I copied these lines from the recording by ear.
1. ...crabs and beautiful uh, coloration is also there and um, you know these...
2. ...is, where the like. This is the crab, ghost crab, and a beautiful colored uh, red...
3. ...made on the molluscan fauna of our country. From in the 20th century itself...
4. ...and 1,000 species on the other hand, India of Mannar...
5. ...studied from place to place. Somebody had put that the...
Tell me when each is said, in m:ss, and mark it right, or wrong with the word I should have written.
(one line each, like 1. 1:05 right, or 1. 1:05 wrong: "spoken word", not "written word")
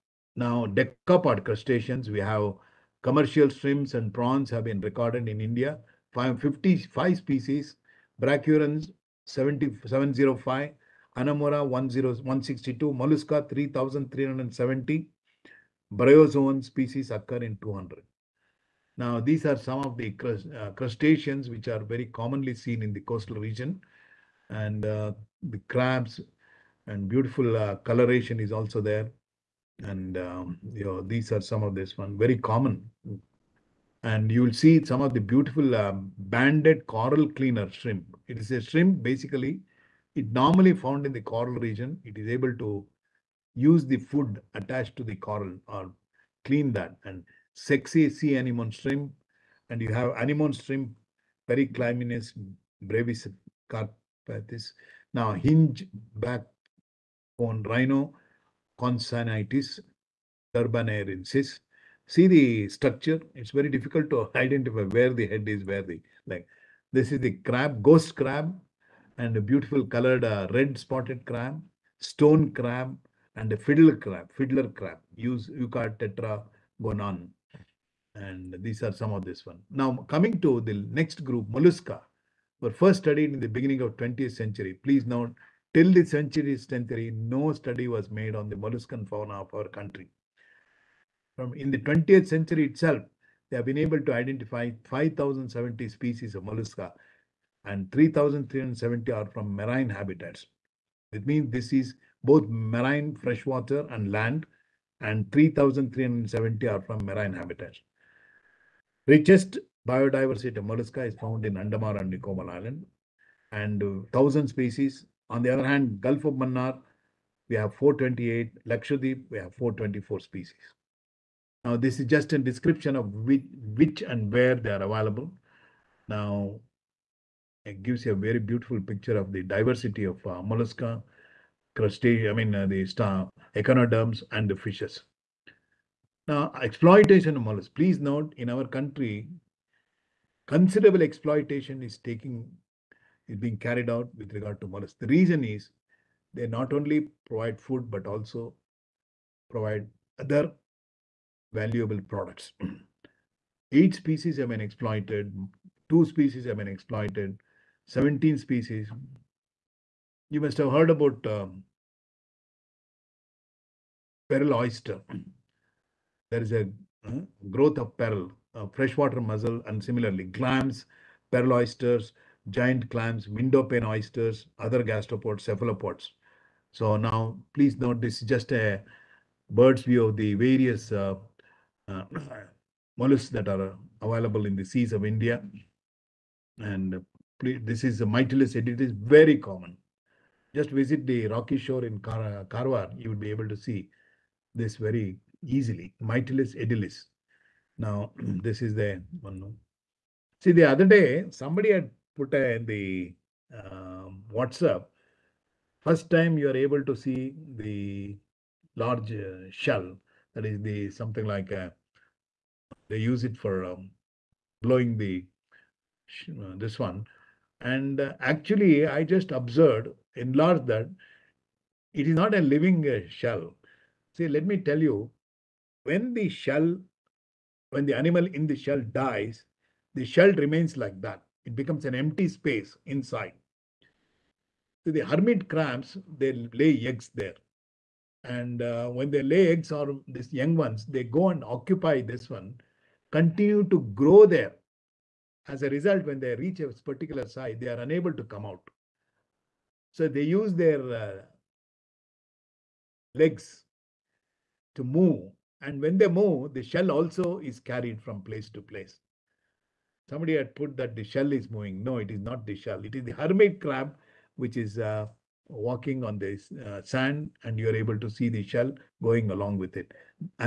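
1. 0:25 right
2. 1:05 right
3. 1:28 right
4. 1:53 wrong: "Gulf", not "India"
5. 4:17 wrong: "carried", not "studied".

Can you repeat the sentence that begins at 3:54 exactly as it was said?
So the hermit crabs, they lay eggs there.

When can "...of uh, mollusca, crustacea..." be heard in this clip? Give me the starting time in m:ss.
2:10.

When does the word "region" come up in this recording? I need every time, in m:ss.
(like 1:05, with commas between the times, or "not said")
0:23, 0:41.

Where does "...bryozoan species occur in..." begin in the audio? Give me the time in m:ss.
0:15.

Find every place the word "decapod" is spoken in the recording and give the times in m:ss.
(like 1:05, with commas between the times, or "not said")
0:00.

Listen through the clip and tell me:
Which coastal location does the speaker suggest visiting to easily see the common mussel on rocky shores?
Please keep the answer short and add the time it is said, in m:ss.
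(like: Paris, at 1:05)
Karwar, at 3:12.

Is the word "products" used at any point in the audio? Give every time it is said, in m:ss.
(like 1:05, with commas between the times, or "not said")
2:32.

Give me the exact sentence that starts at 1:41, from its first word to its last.
It means this is both marine freshwater and land and 3,370 are from marine habitats.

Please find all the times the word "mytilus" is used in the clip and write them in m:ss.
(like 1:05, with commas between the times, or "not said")
3:08, 3:16.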